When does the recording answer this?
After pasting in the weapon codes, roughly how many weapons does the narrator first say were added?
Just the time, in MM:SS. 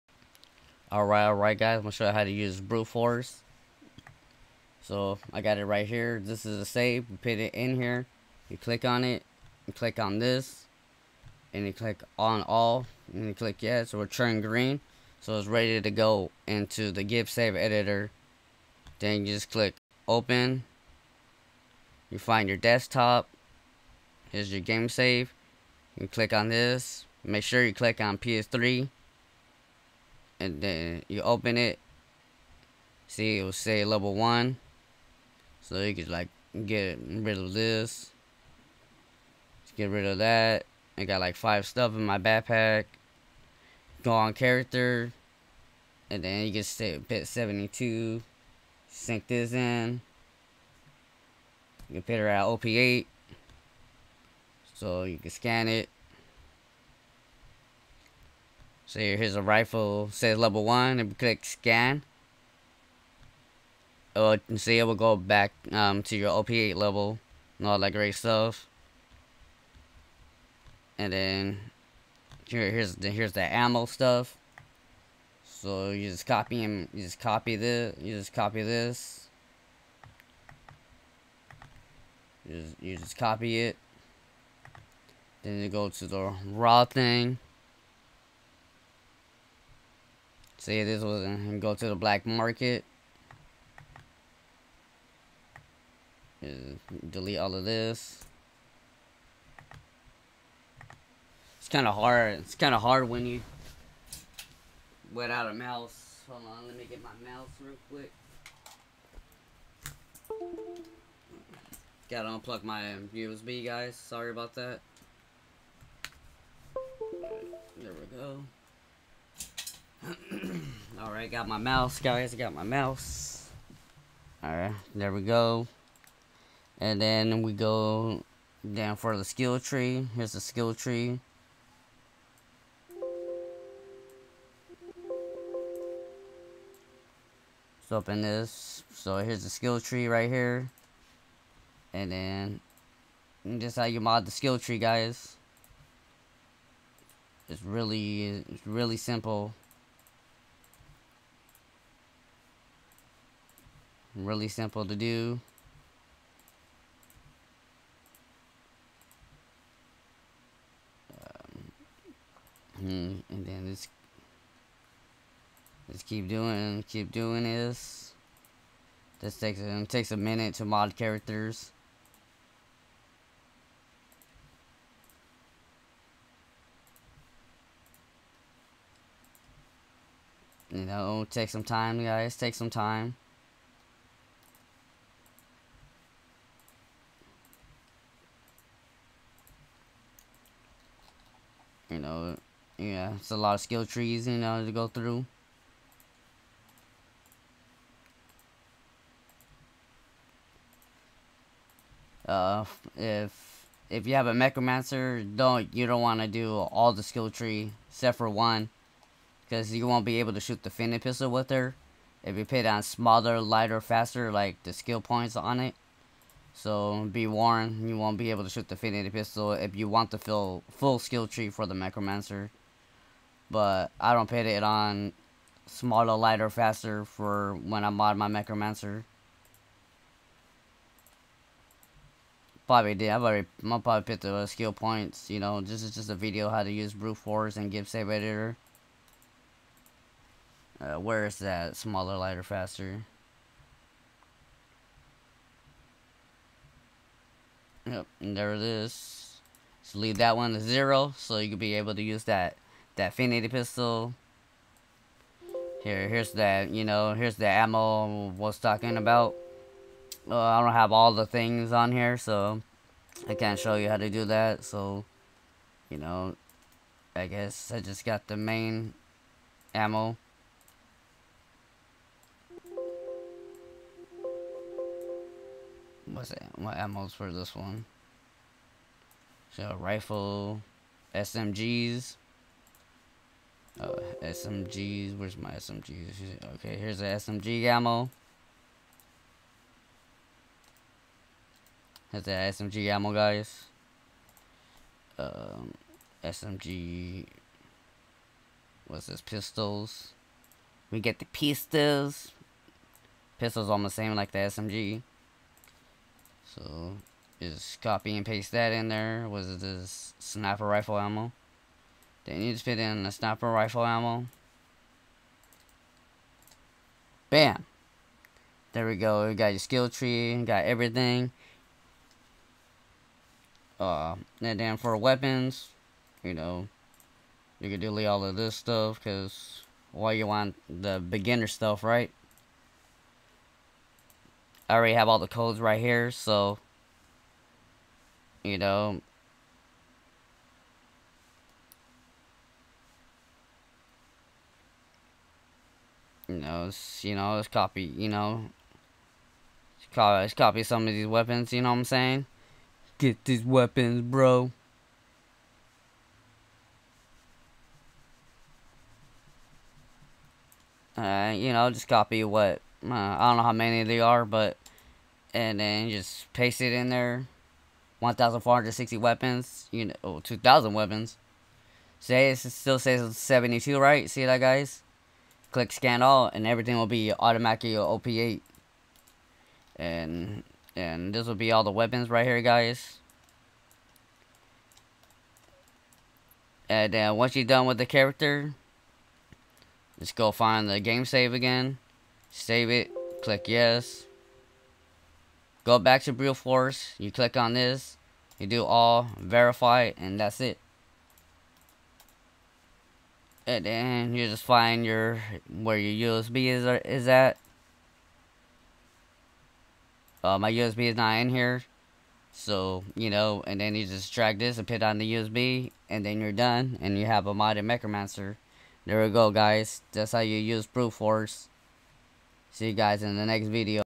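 06:07.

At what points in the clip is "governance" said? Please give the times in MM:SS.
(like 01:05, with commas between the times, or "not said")
not said.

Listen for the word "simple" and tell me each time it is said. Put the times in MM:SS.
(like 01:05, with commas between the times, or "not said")
02:28, 02:34.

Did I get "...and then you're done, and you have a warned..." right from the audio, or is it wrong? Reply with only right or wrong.
wrong.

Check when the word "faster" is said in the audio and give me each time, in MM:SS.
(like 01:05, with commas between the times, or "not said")
03:33, 03:46, 04:02.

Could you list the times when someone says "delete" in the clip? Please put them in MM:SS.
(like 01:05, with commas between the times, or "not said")
01:37, 05:27.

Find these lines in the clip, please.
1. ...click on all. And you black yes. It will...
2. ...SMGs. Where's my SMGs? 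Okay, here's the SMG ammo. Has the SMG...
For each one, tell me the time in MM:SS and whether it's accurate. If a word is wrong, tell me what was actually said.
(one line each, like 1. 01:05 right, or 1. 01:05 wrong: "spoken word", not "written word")
1. 00:11 wrong: "click", not "black"
2. 04:44 right.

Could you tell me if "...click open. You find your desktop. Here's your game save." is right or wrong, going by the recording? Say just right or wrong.
right.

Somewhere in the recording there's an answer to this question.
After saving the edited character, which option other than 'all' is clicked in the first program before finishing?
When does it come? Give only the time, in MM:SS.
06:39.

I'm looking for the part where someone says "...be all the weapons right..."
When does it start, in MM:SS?
06:21.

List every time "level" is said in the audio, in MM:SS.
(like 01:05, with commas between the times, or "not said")
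00:33, 01:00, 01:06.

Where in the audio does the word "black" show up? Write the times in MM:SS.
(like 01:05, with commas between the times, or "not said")
01:31.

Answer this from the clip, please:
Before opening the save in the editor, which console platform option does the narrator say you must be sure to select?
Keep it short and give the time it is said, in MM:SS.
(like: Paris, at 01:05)
PS3, at 00:28.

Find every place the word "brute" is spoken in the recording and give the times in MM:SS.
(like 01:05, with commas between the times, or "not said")
00:02, 03:56, 06:36, 07:00.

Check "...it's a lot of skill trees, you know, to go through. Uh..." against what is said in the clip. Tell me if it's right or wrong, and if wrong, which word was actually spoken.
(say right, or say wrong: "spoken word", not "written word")
right.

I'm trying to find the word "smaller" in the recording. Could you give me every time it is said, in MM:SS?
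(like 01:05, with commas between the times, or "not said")
03:32, 03:45, 04:01.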